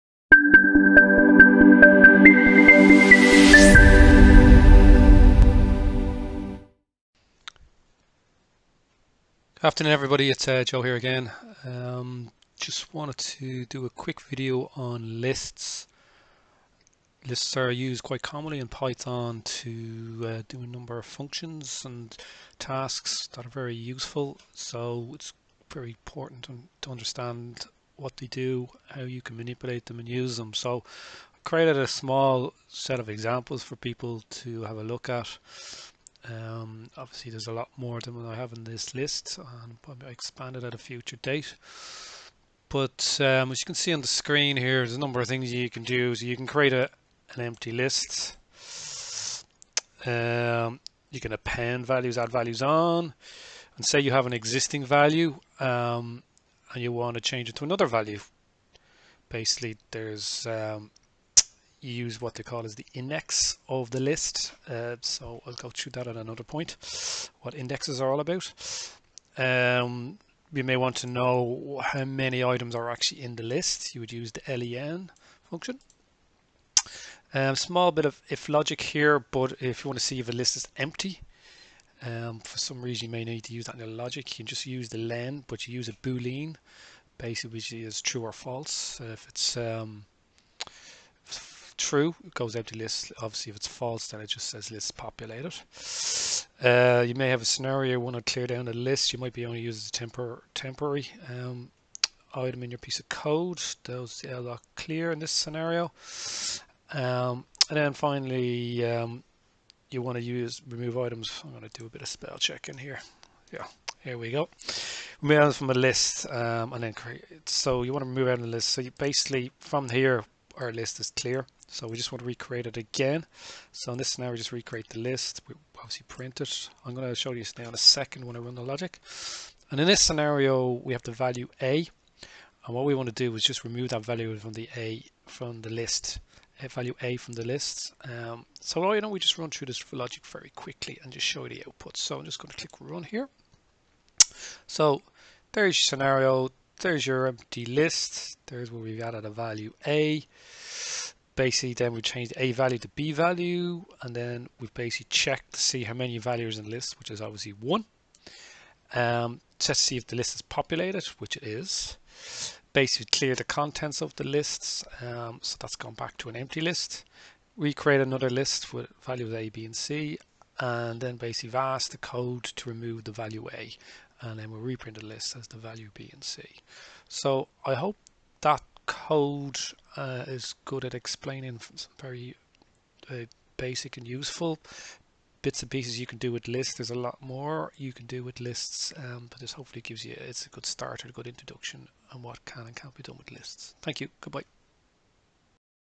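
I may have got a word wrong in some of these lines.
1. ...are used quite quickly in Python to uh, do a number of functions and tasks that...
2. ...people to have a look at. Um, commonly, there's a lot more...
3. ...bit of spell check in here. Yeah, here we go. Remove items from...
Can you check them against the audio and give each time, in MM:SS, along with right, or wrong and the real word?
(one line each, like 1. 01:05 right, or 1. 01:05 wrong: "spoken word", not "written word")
1. 00:17 wrong: "commonly", not "quickly"
2. 00:33 wrong: "obviously", not "commonly"
3. 01:51 right.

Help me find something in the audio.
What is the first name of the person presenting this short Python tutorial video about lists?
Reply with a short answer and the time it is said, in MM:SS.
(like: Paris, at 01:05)
Joe, at 00:10.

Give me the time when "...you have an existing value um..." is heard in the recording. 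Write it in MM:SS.
00:53.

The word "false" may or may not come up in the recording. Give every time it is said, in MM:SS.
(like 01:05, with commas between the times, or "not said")
01:28, 01:33.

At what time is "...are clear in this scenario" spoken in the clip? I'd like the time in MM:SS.
01:44.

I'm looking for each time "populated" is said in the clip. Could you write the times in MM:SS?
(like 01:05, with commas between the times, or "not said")
01:34, 02:40.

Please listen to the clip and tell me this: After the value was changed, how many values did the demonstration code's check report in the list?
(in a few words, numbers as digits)
1.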